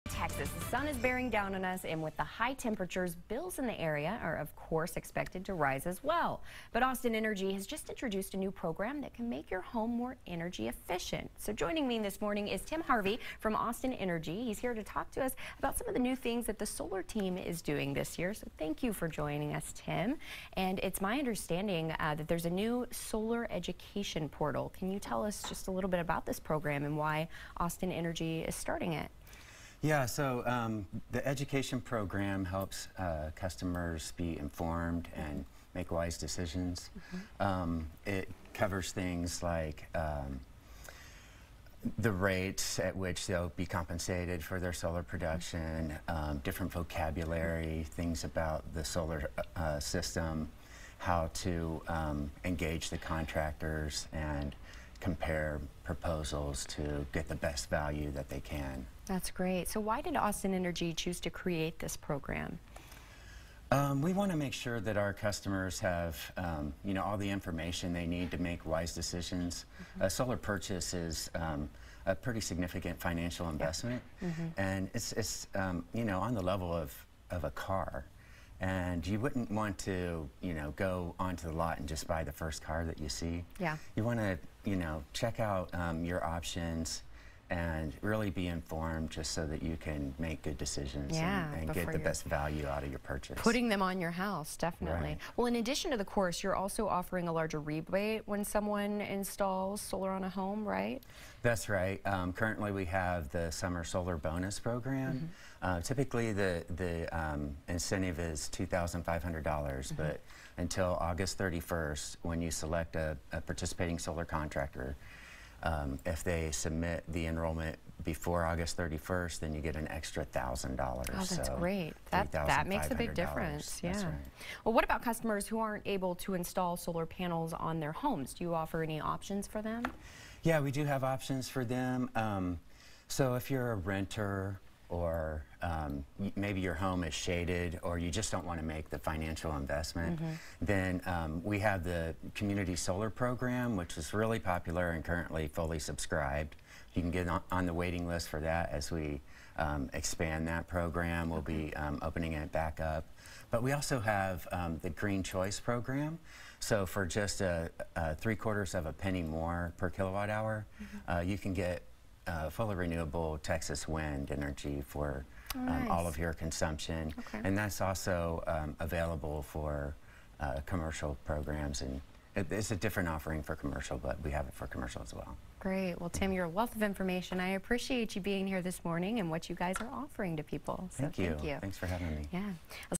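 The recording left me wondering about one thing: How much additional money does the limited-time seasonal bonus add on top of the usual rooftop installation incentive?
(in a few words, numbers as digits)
$1,000.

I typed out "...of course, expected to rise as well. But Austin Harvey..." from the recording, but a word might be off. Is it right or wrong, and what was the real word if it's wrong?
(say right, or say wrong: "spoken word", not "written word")
wrong: "Energy", not "Harvey".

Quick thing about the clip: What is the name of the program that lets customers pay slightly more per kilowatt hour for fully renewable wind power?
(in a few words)
Green Choice.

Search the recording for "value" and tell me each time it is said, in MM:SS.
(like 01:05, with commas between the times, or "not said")
00:57, 01:32.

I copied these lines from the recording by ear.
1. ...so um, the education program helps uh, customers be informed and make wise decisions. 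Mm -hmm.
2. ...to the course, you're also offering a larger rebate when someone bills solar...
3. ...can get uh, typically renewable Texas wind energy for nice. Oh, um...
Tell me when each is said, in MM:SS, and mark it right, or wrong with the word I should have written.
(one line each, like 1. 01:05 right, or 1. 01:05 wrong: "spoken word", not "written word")
1. 00:30 right
2. 01:35 wrong: "installs", not "bills"
3. 02:41 wrong: "fully", not "typically".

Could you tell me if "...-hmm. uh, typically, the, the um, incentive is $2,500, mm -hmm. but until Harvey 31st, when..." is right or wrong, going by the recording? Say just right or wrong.
wrong.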